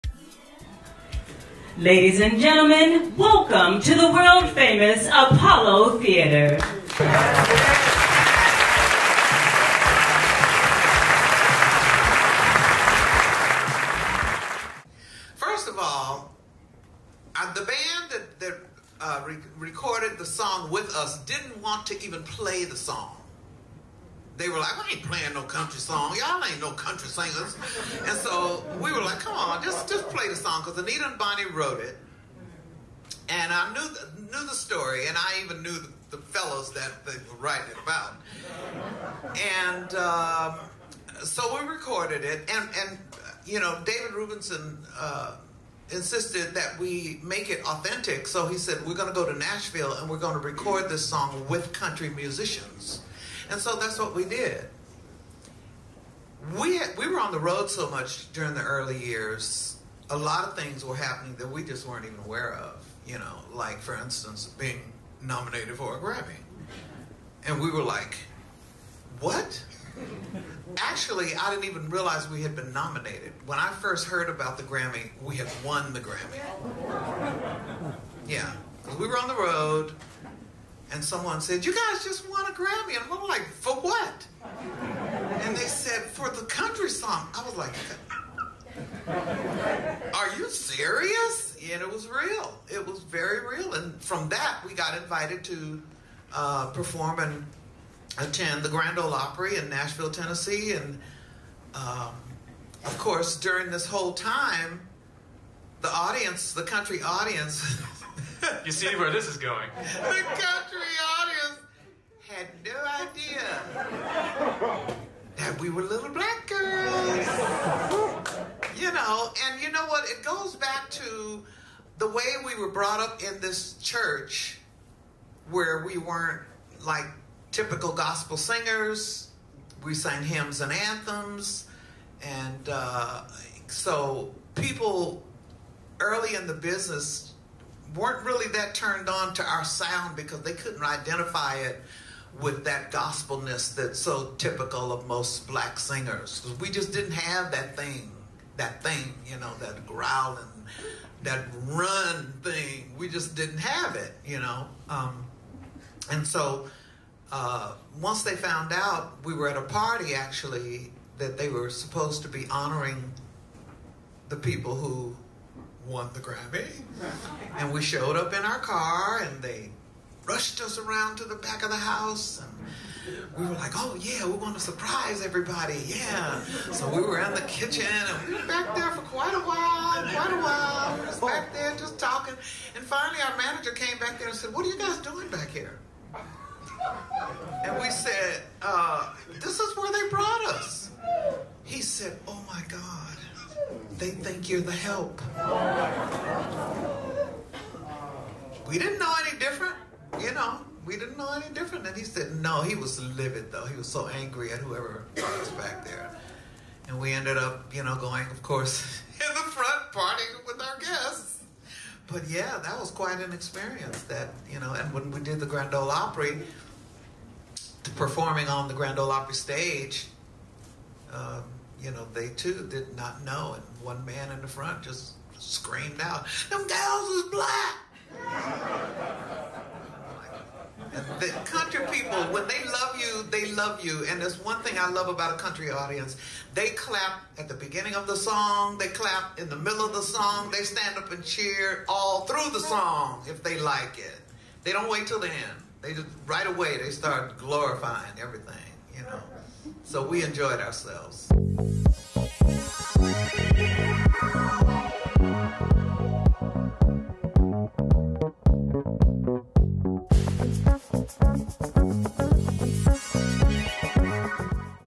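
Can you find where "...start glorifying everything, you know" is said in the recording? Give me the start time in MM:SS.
04:06.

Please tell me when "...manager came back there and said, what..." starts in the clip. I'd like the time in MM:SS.
03:03.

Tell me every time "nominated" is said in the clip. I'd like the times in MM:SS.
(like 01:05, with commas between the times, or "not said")
01:05, 01:12.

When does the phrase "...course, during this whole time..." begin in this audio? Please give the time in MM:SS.
01:42.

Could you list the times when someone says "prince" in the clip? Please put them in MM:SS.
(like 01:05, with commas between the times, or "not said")
not said.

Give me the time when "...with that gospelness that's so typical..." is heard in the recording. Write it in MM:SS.
02:22.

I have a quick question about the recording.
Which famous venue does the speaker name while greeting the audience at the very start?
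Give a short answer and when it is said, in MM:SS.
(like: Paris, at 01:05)
Apollo Theater, at 00:05.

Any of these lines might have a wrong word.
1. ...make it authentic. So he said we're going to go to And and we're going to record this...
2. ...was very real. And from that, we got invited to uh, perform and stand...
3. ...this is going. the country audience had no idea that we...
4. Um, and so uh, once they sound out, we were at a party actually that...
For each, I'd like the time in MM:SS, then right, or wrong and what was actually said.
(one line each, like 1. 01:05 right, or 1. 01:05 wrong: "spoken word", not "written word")
1. 00:47 wrong: "Nashville", not "And"
2. 01:32 wrong: "attend", not "stand"
3. 01:49 right
4. 02:34 wrong: "found", not "sound".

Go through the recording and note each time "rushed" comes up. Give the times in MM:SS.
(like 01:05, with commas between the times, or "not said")
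02:50.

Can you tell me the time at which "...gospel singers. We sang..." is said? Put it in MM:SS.
02:07.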